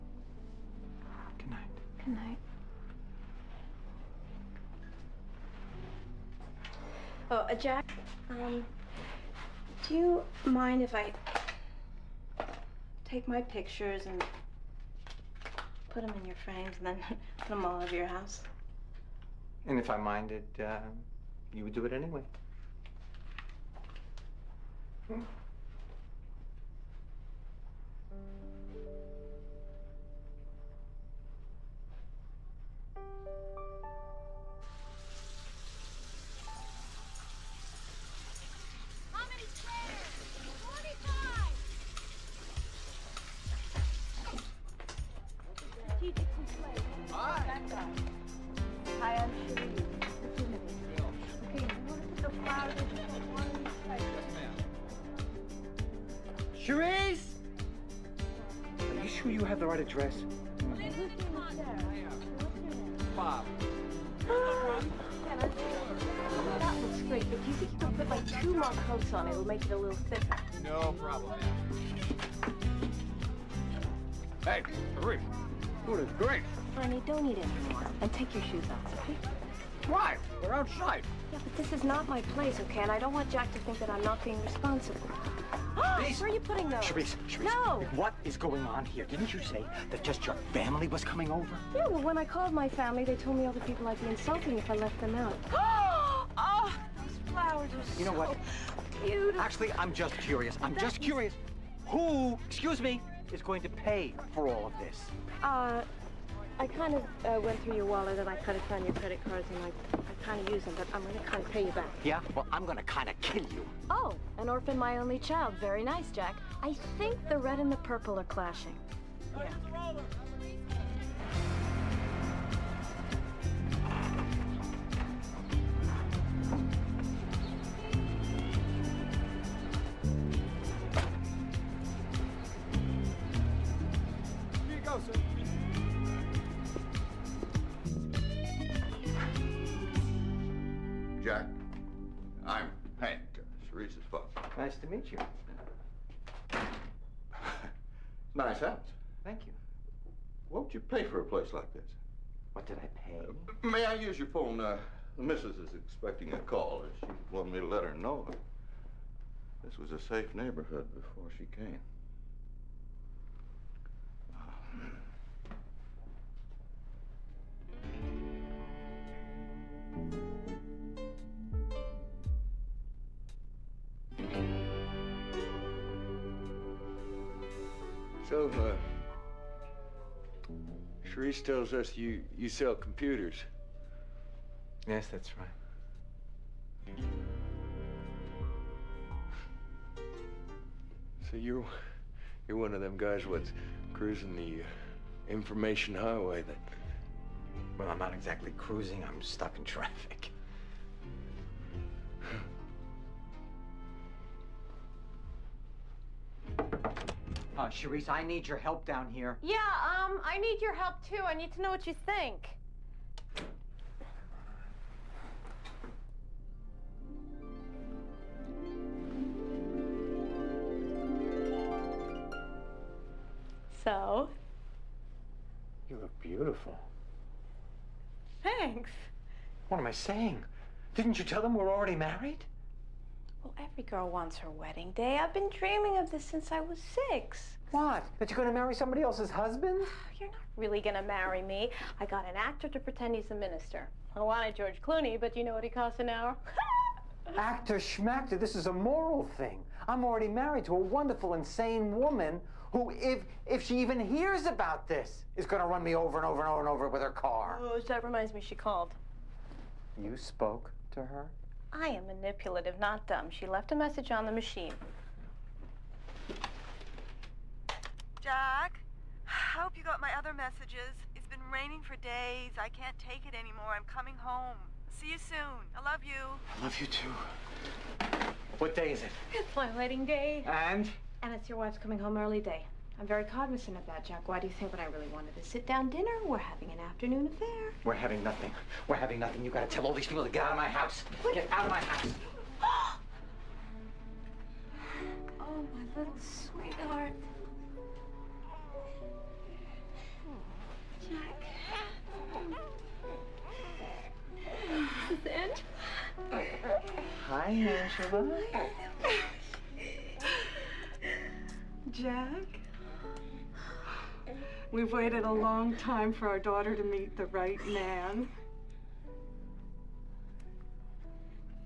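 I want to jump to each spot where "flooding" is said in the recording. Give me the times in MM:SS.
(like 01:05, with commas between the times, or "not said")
not said.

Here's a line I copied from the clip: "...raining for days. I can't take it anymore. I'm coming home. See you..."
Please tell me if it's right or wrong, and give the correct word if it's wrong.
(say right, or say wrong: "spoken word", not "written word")
right.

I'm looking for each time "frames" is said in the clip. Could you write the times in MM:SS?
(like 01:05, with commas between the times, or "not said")
00:16.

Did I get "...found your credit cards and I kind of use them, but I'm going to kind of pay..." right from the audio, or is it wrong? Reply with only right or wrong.
right.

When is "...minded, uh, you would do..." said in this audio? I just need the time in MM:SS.
00:19.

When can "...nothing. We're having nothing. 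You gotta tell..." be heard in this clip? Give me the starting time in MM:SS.
04:48.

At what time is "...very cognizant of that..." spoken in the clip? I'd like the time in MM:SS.
04:43.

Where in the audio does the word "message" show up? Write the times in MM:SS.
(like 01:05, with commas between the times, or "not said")
04:23, 04:30.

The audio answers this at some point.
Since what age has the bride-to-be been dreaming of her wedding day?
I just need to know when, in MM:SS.
03:57.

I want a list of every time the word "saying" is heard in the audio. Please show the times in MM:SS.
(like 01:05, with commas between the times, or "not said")
03:49.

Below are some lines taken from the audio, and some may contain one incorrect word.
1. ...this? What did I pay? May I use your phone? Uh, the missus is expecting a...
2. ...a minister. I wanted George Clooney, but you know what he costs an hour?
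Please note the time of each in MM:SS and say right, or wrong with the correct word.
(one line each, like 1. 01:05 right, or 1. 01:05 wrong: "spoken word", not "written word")
1. 02:31 right
2. 04:03 right.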